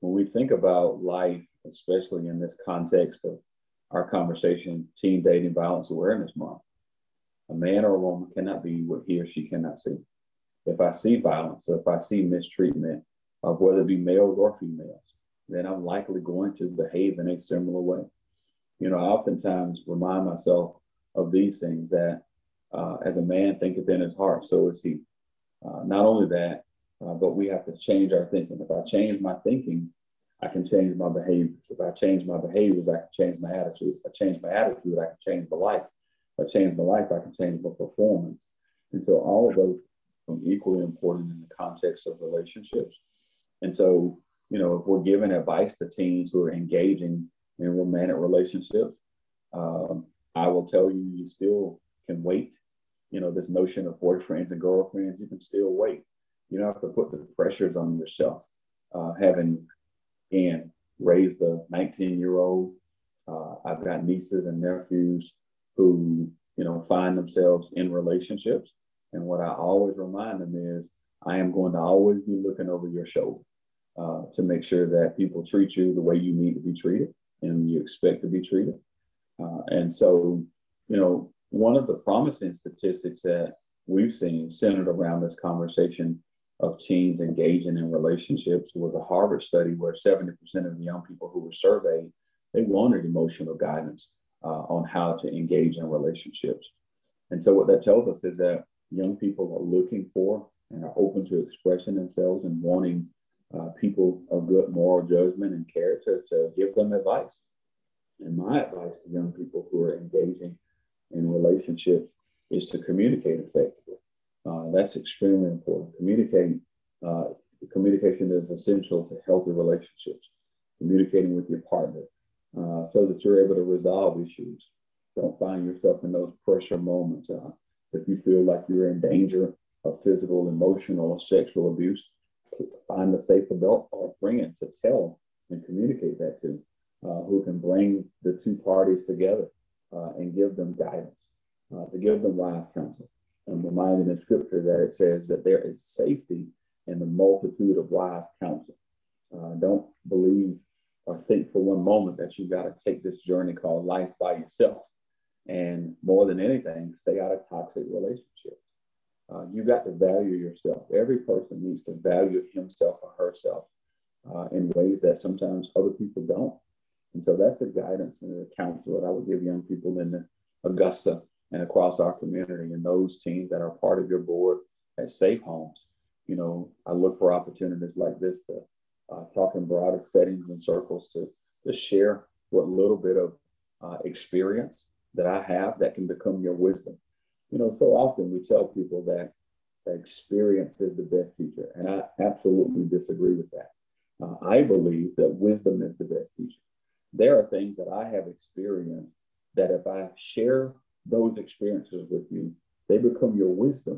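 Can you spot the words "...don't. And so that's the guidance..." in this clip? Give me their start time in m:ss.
2:46.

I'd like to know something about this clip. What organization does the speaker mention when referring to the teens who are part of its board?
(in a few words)
SafeHomes.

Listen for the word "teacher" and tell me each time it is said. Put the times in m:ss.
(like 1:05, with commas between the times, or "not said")
3:11, 3:16.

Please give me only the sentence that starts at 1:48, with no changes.
And my advice to young people who are engaging in relationships is to communicate effectively.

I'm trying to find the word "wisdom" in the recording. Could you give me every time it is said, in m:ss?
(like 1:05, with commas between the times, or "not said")
3:06, 3:15.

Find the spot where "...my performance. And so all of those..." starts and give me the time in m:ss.
0:37.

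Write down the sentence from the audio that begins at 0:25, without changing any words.
Uh, not only that, uh, but we have to change our thinking.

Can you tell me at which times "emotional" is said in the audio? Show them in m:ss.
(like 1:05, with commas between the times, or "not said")
1:33, 2:10.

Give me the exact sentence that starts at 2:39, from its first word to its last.
Uh, you've got to value yourself.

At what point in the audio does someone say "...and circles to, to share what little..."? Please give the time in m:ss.
3:00.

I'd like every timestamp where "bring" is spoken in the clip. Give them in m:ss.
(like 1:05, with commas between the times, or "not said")
2:17.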